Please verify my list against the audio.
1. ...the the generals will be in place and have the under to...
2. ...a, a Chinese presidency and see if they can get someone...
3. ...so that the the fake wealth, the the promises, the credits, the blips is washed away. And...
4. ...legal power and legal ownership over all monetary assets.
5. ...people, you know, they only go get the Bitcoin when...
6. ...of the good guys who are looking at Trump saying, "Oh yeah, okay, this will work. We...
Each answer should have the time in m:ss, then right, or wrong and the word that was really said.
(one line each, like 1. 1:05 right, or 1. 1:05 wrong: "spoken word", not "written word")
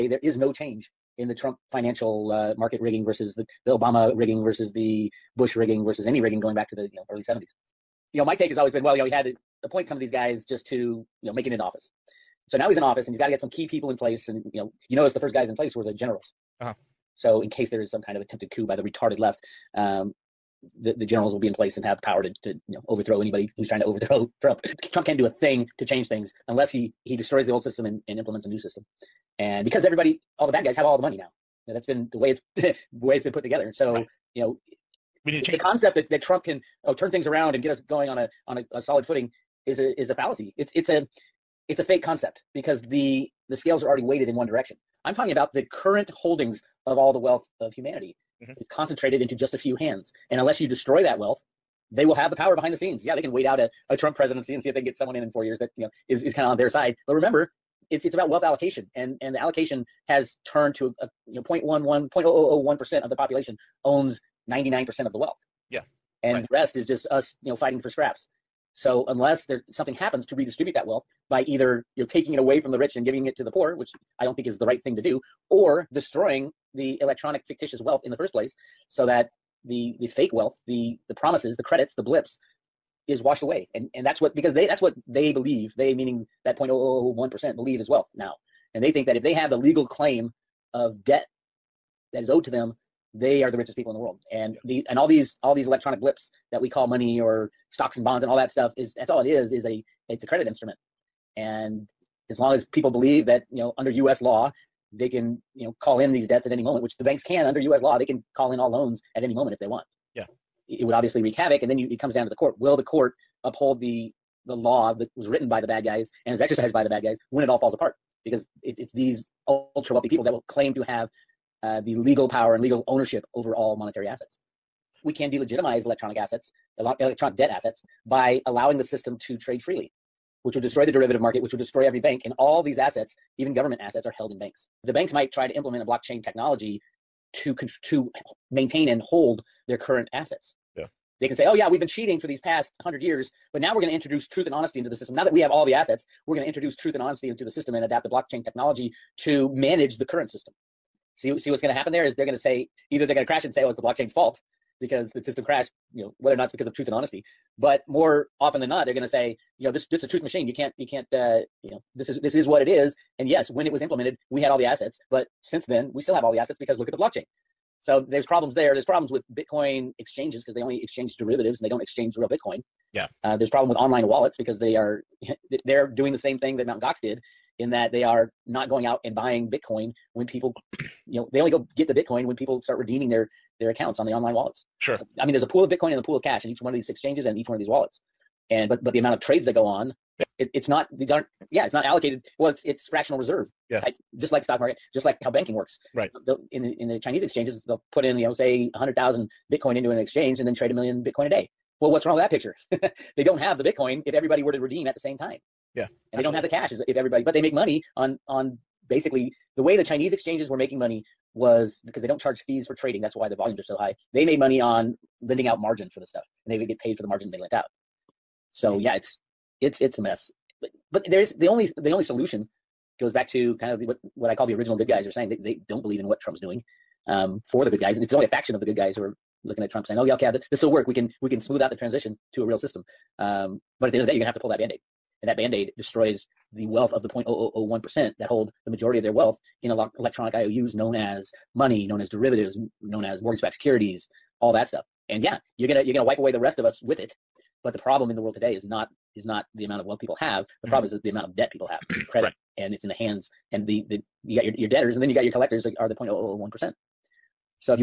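1. 0:20 wrong: "power", not "under"
2. 0:53 wrong: "Trump", not "Chinese"
3. 1:18 right
4. 2:01 right
5. 3:00 right
6. 3:48 right.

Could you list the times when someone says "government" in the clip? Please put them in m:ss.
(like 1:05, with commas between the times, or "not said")
2:13.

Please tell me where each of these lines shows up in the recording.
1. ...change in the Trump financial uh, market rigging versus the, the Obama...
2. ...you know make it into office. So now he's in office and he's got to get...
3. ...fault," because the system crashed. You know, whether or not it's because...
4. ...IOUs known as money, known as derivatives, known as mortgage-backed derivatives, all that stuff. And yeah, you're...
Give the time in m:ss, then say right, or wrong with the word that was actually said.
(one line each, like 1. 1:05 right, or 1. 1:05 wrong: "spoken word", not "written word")
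1. 0:00 right
2. 0:11 right
3. 2:34 right
4. 4:00 wrong: "securities", not "derivatives".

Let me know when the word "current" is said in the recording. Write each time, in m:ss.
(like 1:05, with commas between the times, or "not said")
0:45, 2:19, 2:30.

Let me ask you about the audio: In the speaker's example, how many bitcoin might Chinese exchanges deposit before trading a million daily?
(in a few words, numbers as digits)
100,000.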